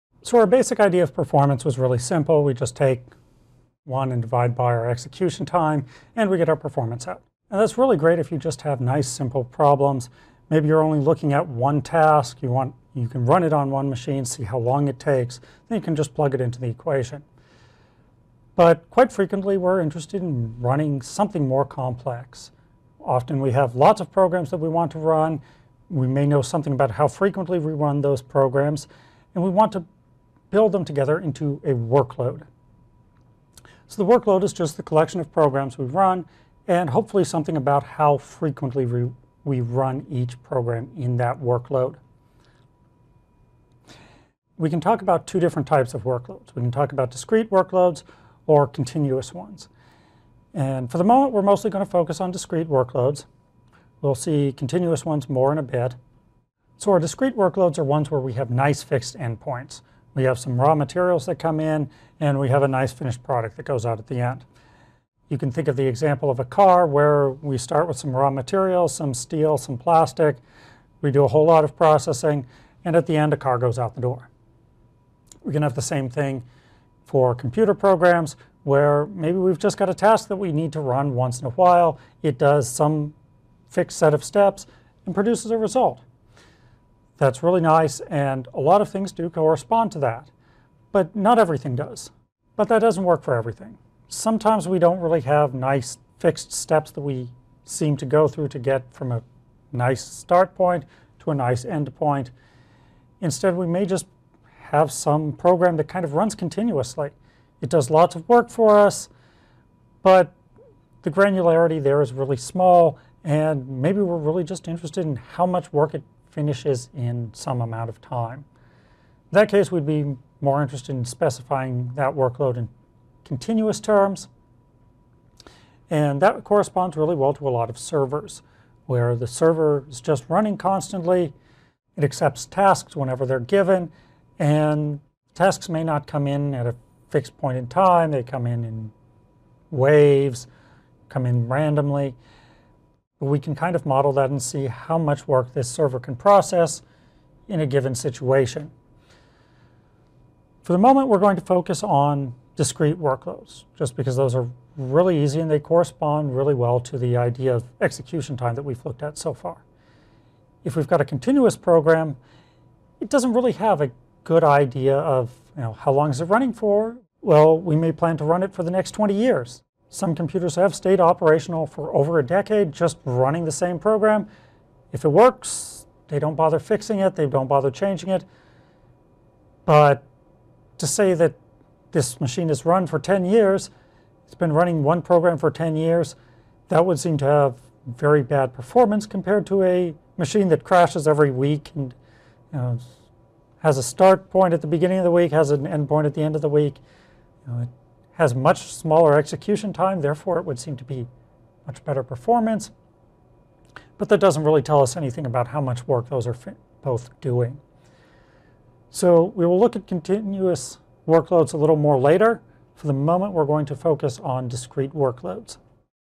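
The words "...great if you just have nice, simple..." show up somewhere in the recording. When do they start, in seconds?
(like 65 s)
7 s.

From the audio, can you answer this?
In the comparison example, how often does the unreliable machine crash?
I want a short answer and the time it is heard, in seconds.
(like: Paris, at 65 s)
Every week, at 191 s.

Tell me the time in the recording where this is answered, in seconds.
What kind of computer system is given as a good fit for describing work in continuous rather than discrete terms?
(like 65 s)
127 s.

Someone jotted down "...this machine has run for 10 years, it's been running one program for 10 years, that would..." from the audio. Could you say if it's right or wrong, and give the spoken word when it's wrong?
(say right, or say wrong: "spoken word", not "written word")
right.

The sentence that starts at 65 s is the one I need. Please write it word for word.
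You can think of the example of a car where we start with some raw materials, some steel, some plastic.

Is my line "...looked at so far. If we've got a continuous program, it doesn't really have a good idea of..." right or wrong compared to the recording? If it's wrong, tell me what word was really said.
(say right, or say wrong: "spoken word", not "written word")
right.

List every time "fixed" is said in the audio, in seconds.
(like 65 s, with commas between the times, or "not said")
58 s, 83 s, 96 s, 137 s.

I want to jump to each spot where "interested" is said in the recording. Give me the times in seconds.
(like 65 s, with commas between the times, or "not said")
19 s, 114 s, 120 s.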